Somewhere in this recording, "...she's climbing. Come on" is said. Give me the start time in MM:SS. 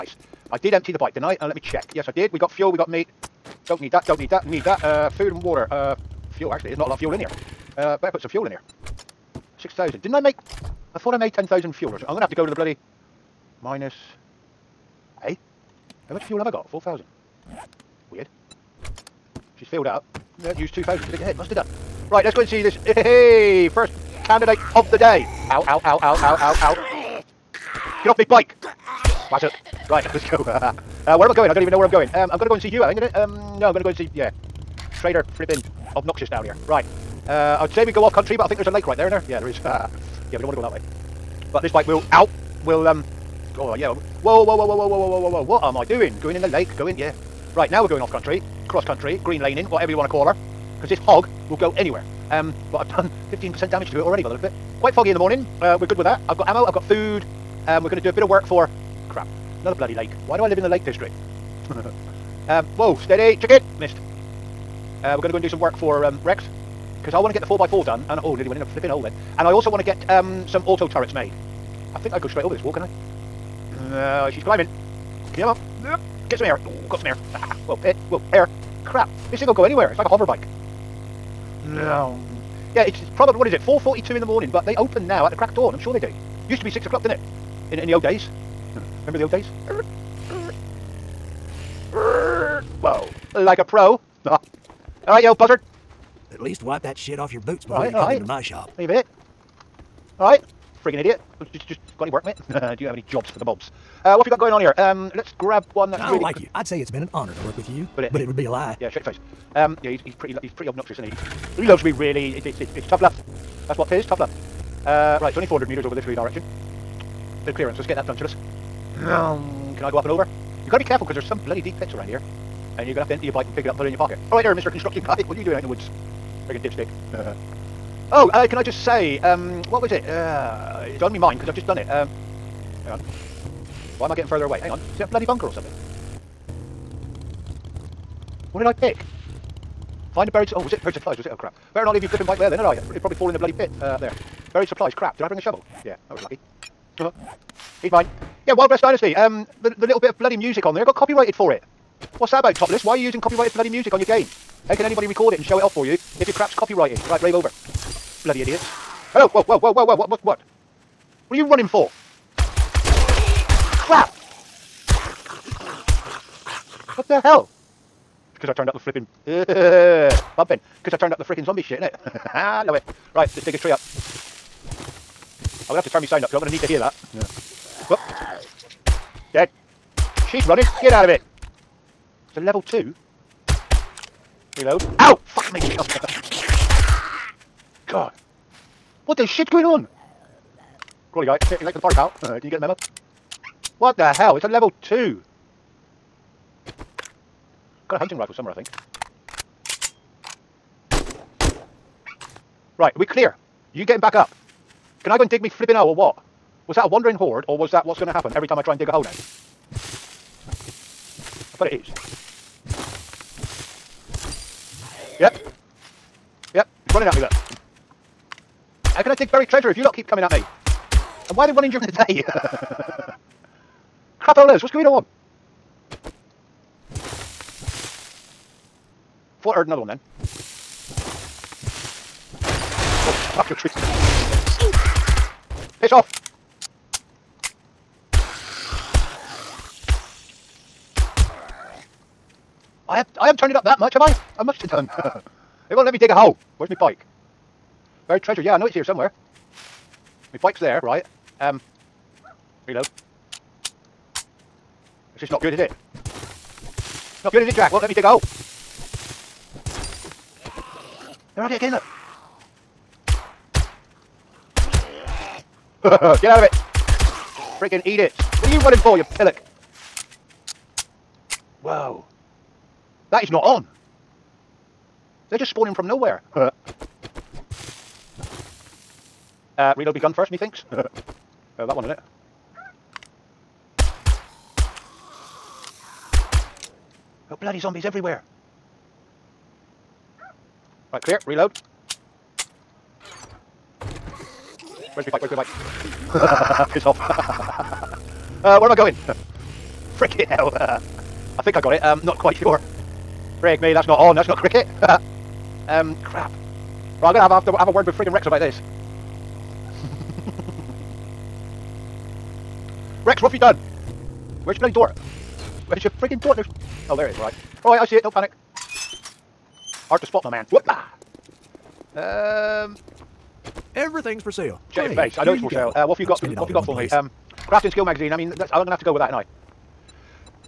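01:14.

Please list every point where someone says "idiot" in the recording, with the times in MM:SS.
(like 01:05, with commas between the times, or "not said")
01:40, 02:38.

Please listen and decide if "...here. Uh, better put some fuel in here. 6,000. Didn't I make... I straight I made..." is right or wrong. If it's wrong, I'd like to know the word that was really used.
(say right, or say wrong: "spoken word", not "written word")
wrong: "thought", not "straight".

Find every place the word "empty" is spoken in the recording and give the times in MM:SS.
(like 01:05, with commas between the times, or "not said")
00:00, 02:03.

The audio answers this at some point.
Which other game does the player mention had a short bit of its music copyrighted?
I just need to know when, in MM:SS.
02:28.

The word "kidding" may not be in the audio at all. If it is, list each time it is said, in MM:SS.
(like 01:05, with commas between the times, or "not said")
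not said.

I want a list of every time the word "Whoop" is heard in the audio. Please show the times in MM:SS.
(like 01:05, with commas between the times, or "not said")
02:57, 05:20.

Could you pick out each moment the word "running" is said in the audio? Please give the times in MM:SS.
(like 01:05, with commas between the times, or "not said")
02:41, 03:00, 03:36, 03:41, 04:28.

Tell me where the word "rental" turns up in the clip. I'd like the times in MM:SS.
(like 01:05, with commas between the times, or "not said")
not said.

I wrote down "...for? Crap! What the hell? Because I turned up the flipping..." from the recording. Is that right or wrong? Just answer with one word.
right.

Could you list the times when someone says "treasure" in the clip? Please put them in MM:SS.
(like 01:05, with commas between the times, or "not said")
03:39, 04:08.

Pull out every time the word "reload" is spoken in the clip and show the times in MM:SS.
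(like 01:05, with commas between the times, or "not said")
03:04, 04:12, 04:39, 04:51.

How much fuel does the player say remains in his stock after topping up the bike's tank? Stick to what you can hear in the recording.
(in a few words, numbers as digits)
4,000.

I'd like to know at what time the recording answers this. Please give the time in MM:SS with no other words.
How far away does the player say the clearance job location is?
01:55.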